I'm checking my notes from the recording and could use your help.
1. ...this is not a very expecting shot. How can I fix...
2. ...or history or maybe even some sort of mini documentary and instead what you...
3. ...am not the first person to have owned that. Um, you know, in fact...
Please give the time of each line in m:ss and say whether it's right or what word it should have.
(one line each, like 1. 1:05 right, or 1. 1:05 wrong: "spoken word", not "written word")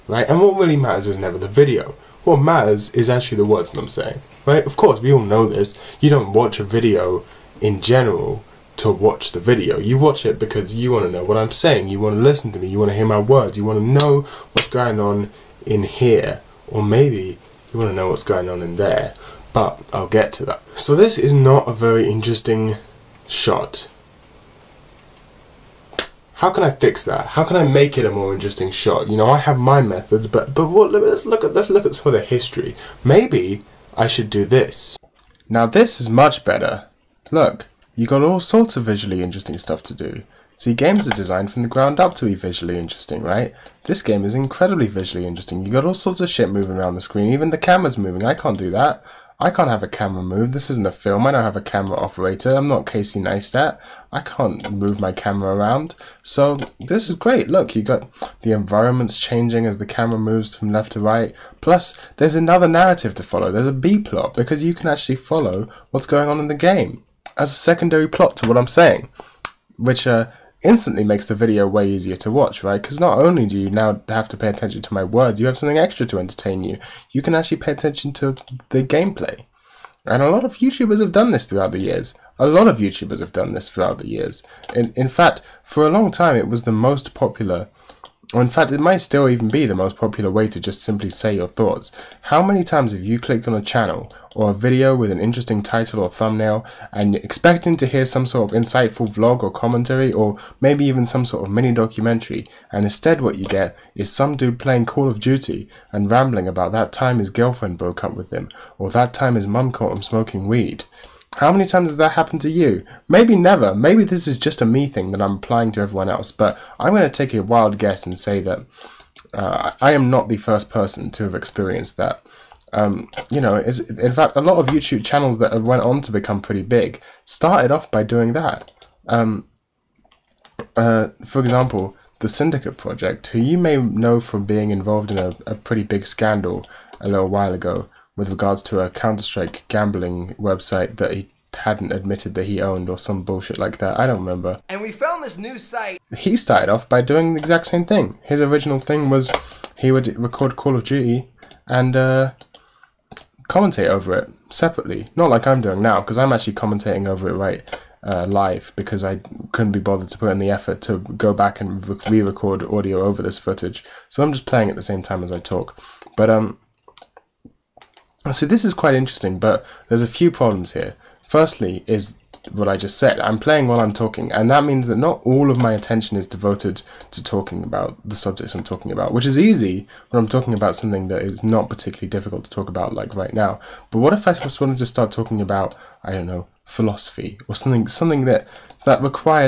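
1. 0:20 wrong: "interesting", not "expecting"
2. 1:39 wrong: "commentary", not "history"
3. 1:59 wrong: "experienced", not "owned".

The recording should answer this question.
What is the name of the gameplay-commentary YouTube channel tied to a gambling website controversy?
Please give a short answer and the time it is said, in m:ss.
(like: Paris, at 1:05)
The Syndicate Project, at 2:12.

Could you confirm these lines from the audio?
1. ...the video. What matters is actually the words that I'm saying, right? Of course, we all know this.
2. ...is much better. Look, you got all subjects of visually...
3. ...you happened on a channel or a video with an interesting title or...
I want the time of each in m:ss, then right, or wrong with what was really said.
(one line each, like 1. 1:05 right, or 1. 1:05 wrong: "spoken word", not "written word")
1. 0:01 right
2. 0:36 wrong: "sorts", not "subjects"
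3. 1:33 wrong: "clicked", not "happened".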